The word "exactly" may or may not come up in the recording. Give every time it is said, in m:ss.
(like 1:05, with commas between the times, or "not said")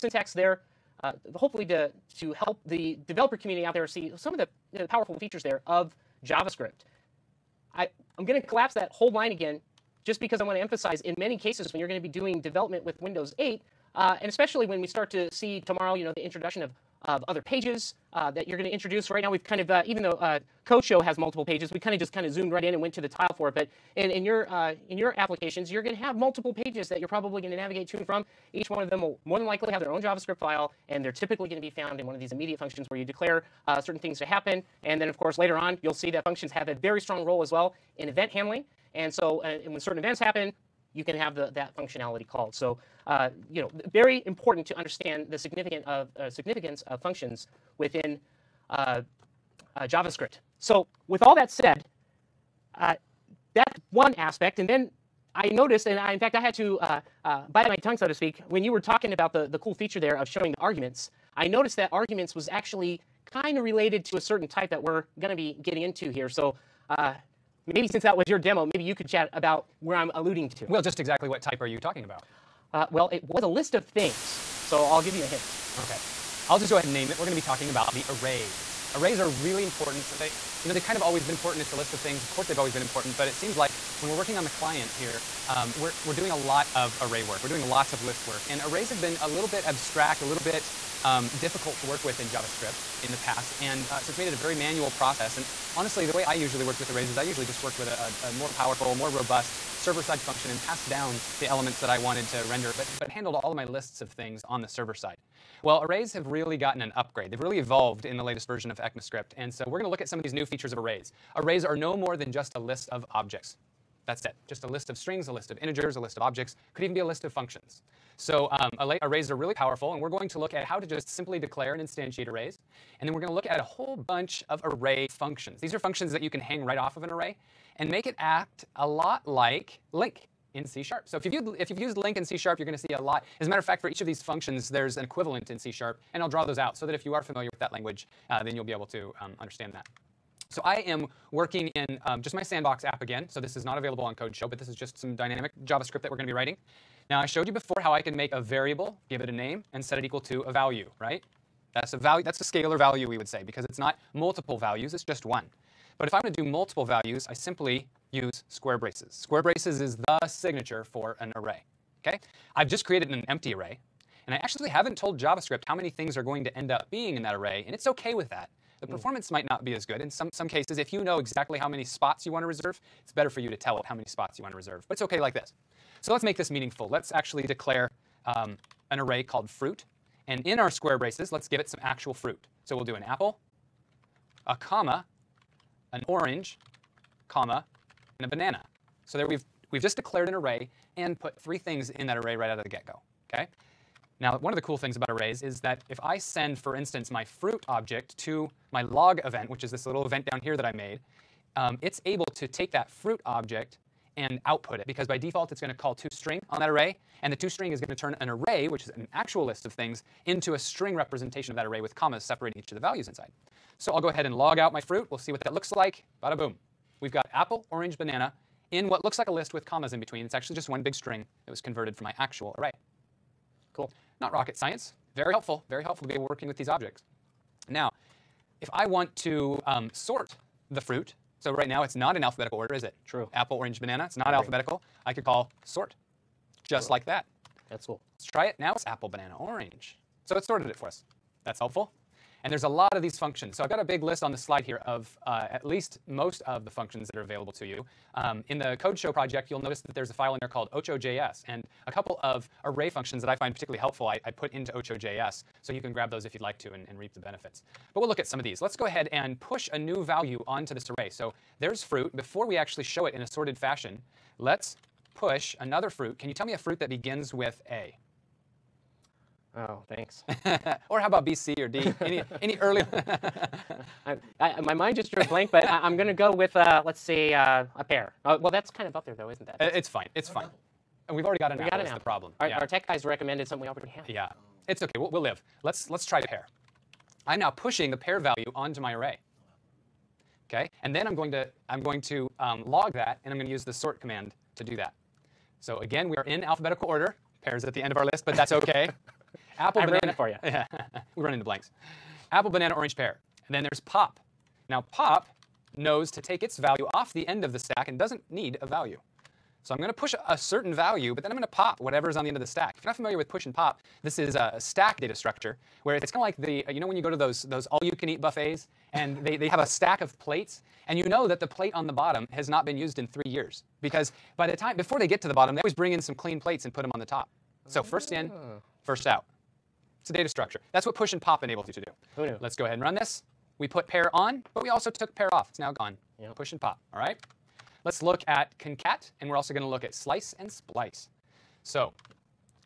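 1:10, 2:51.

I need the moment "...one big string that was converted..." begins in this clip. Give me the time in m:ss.
3:40.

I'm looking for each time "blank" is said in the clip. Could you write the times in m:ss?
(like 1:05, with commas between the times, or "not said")
4:35, 5:01.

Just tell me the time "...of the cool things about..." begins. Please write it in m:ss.
3:14.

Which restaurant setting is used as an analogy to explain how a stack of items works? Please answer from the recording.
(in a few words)
all-you-can-eat buffets.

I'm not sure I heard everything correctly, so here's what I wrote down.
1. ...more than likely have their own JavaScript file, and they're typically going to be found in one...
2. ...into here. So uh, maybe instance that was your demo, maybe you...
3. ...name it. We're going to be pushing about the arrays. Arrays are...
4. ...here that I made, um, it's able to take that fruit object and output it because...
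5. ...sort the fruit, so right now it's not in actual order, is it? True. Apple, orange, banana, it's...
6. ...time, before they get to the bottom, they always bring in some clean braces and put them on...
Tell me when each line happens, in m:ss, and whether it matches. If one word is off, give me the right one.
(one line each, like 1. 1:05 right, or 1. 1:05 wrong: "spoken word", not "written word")
1. 0:29 right
2. 1:05 wrong: "since", not "instance"
3. 1:16 wrong: "talking", not "pushing"
4. 3:20 right
5. 3:49 wrong: "alphabetical", not "actual"
6. 5:24 wrong: "plates", not "braces".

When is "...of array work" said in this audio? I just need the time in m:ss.
1:26.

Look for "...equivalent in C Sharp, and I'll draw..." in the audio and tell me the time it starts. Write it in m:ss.
2:15.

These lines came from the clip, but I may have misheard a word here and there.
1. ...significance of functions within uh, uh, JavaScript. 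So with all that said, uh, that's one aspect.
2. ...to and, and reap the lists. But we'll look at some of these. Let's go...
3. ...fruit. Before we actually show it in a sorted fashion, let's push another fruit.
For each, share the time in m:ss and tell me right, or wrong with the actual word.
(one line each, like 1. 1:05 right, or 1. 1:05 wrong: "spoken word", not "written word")
1. 0:46 right
2. 4:16 wrong: "benefits", not "lists"
3. 4:21 right.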